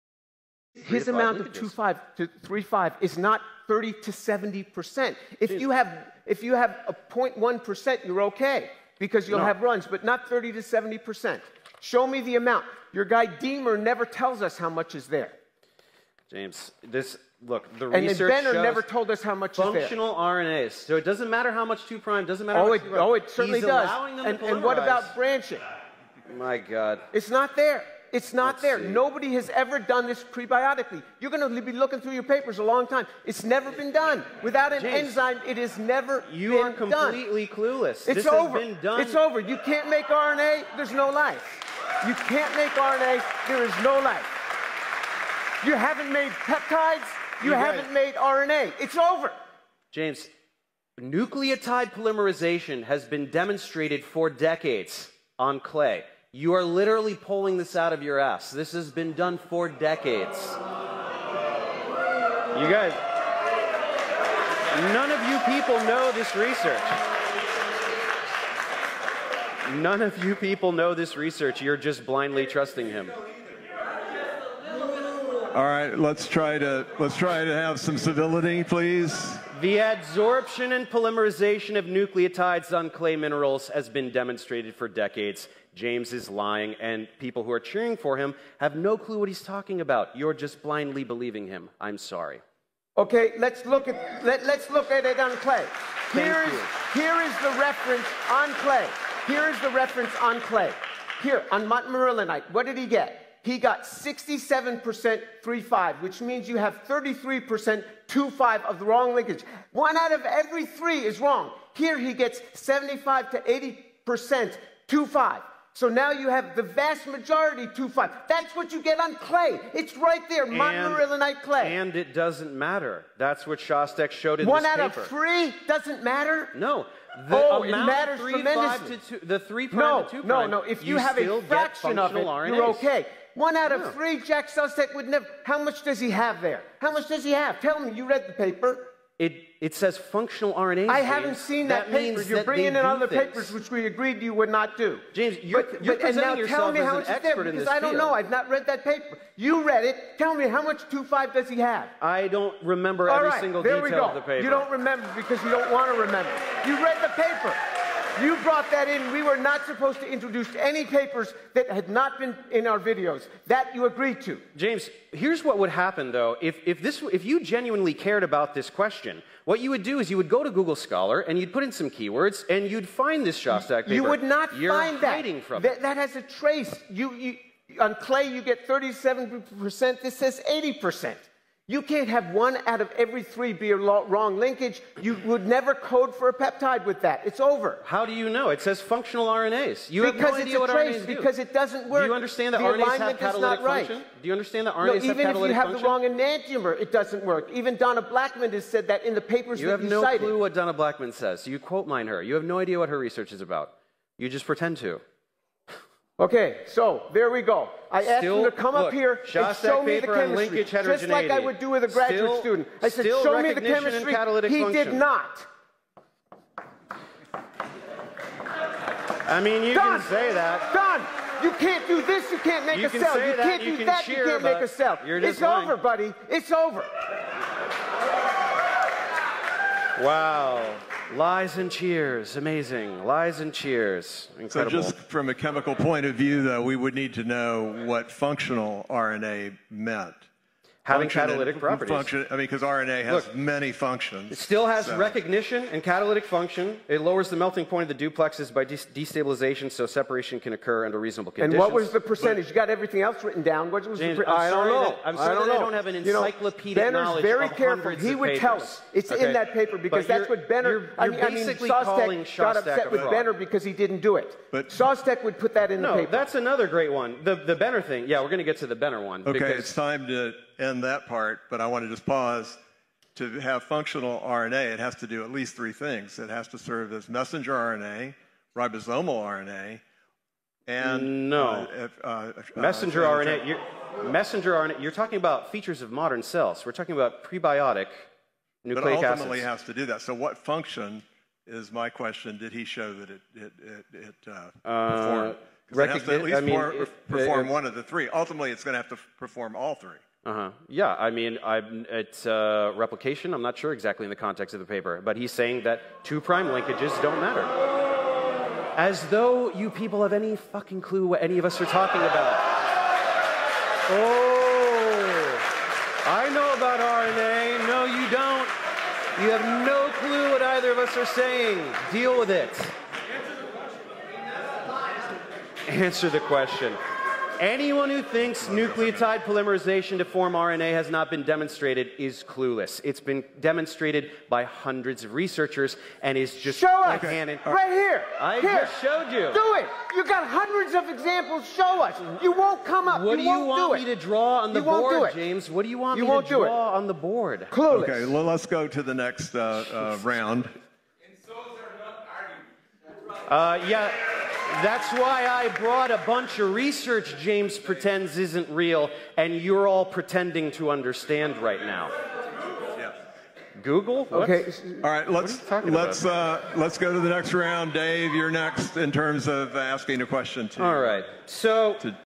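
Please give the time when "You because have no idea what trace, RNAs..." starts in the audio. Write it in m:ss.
3:09.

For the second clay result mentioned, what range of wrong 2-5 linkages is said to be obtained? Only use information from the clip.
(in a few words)
75 to 80%.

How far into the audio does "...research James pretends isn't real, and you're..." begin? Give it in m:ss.
5:56.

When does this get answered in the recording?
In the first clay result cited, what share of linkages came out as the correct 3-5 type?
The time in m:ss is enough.
1:43.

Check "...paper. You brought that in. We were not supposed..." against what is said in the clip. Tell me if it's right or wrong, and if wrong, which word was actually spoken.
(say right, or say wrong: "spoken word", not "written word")
right.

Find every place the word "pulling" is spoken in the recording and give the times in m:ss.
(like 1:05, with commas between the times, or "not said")
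0:57.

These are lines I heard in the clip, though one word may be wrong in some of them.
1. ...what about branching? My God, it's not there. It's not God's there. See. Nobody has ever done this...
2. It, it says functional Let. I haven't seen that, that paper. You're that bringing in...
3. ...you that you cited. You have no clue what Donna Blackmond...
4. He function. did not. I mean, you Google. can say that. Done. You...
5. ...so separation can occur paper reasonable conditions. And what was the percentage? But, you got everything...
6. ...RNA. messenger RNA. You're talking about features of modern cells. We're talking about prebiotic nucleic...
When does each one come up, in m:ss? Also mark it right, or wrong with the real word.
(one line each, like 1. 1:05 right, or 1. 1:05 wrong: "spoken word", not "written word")
1. 0:24 wrong: "Let", not "God"
2. 2:19 wrong: "RNA", not "Let"
3. 3:19 right
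4. 3:34 wrong: "Done", not "Google"
5. 4:09 wrong: "under", not "paper"
6. 4:43 right.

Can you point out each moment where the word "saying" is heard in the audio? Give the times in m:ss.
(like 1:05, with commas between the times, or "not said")
5:05, 5:21.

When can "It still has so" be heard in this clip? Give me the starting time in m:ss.
4:04.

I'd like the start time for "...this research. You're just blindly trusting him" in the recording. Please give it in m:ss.
1:10.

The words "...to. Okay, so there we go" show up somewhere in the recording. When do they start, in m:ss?
3:24.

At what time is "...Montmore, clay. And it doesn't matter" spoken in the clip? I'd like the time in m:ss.
2:00.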